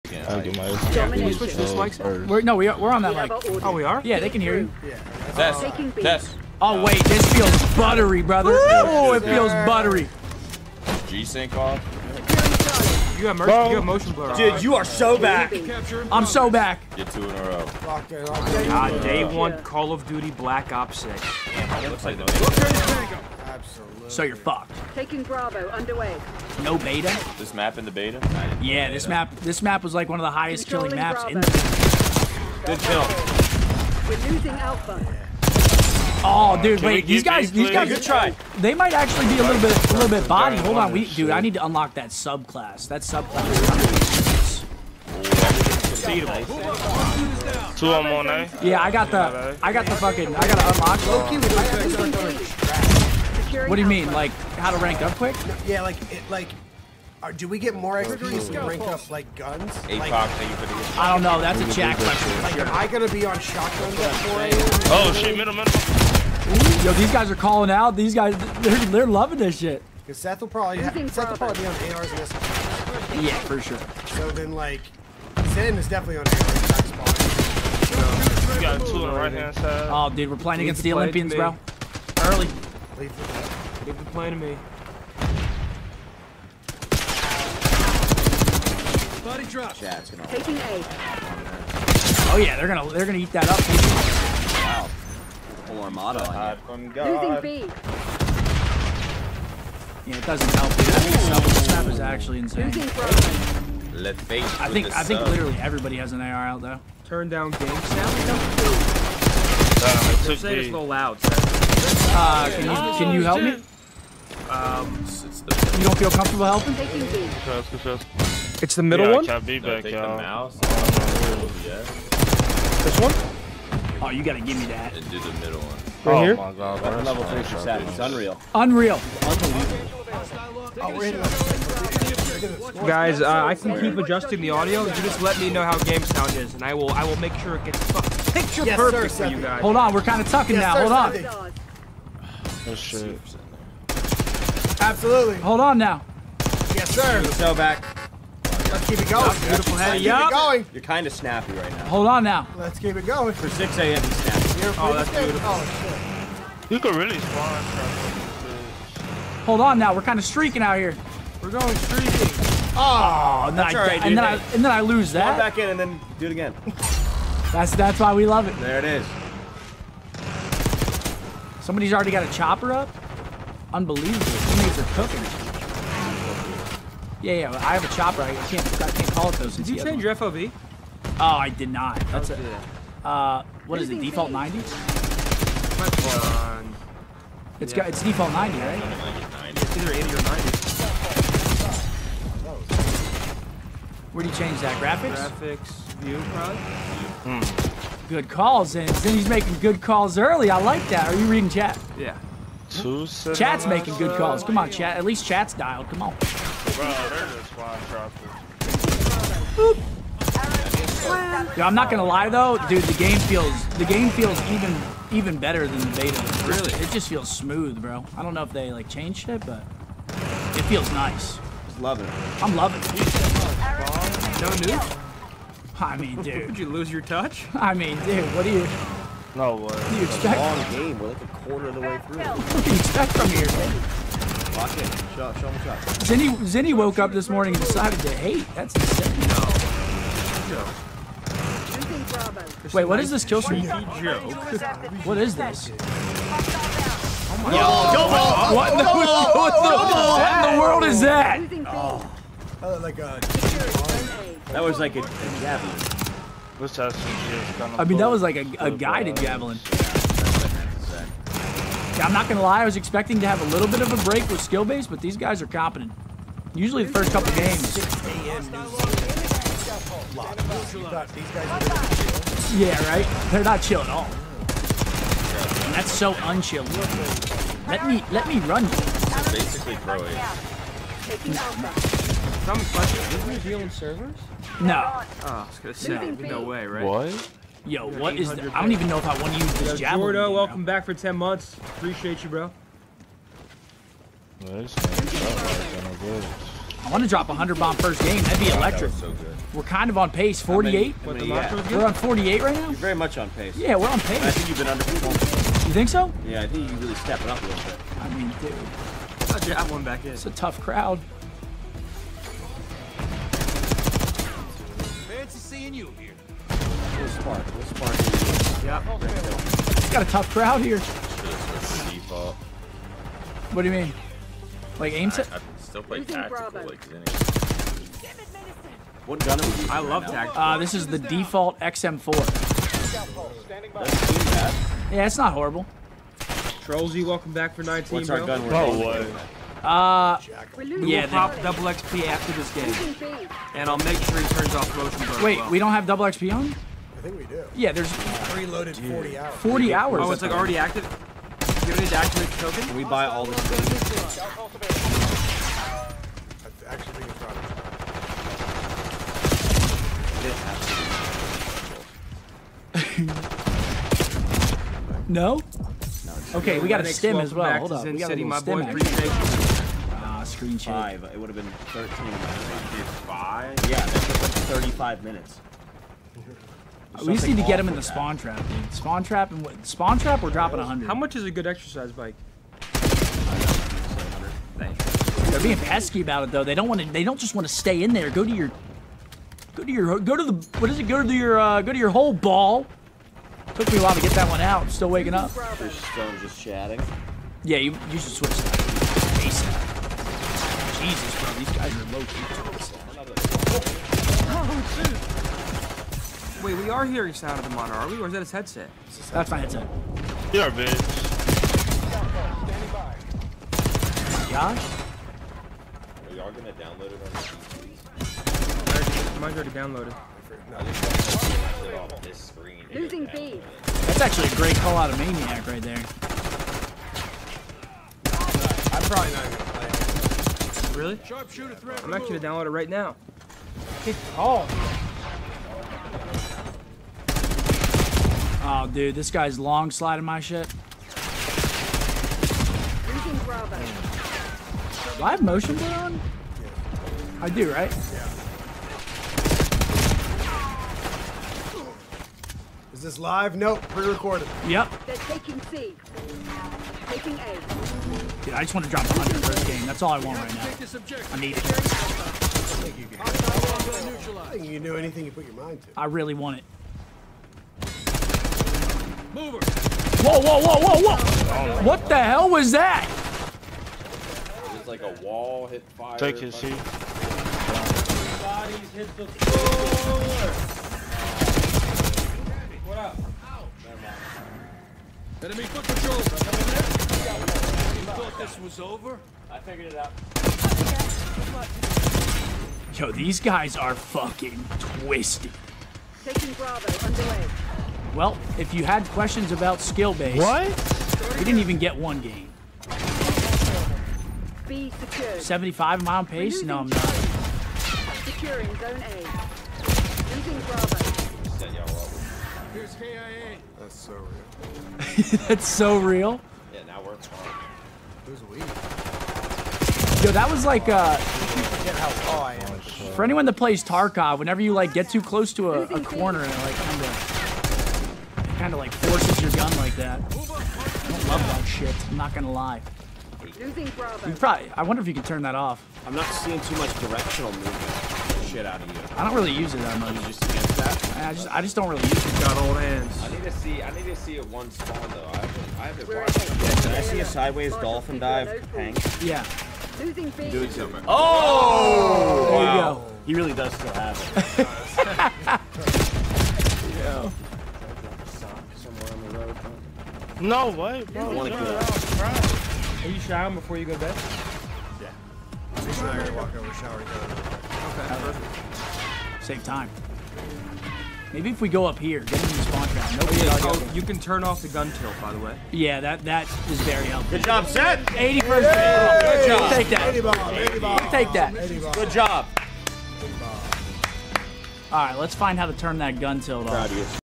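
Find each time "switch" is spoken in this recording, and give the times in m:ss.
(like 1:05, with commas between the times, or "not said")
0:01, 6:38.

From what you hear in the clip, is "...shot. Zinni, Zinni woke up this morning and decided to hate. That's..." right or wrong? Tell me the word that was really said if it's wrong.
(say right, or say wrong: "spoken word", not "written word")
right.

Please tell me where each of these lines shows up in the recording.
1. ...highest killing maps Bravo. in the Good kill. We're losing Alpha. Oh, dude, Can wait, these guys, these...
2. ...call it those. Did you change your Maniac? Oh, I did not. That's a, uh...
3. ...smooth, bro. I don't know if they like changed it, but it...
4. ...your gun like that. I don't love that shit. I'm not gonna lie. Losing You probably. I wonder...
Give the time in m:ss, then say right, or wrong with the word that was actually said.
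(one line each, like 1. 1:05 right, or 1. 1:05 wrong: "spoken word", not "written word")
1. 0:30 right
2. 2:59 wrong: "FOV", not "Maniac"
3. 3:37 right
4. 8:49 right.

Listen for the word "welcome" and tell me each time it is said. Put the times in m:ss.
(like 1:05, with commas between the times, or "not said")
4:50, 5:37.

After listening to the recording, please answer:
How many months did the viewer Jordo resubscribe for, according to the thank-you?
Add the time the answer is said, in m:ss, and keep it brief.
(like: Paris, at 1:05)
10 months, at 4:50.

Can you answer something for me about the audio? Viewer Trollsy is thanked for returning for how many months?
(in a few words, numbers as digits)
19.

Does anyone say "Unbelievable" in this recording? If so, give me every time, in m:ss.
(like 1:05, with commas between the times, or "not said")
2:09, 2:53.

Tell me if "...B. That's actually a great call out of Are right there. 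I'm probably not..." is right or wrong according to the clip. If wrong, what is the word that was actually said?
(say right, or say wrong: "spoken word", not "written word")
wrong: "Maniac", not "Are".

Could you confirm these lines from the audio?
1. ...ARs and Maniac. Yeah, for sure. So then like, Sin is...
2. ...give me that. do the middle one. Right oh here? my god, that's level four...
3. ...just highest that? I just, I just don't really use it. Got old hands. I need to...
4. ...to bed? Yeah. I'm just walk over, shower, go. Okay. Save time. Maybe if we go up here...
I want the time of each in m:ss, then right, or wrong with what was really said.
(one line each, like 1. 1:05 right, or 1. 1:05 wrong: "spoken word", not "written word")
1. 1:11 wrong: "SMGs", not "Maniac"
2. 2:04 wrong: "three", not "four"
3. 9:00 wrong: "against", not "highest"
4. 9:23 right.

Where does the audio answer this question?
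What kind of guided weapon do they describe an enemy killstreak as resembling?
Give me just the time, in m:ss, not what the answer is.
4:18.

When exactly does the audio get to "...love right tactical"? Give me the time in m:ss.
5:29.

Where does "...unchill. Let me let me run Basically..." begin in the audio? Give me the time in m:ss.
4:36.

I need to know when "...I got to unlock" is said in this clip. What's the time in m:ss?
0:50.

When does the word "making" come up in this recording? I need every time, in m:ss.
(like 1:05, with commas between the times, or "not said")
3:19, 3:23.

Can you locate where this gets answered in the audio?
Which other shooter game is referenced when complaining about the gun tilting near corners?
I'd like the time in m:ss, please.
8:43.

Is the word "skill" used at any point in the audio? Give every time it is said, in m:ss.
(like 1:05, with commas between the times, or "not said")
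4:24, 8:19.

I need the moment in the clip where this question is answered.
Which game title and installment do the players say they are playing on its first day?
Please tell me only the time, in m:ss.
0:19.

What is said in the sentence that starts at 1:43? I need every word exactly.
Let's face I think I think literally everybody has an AR out though.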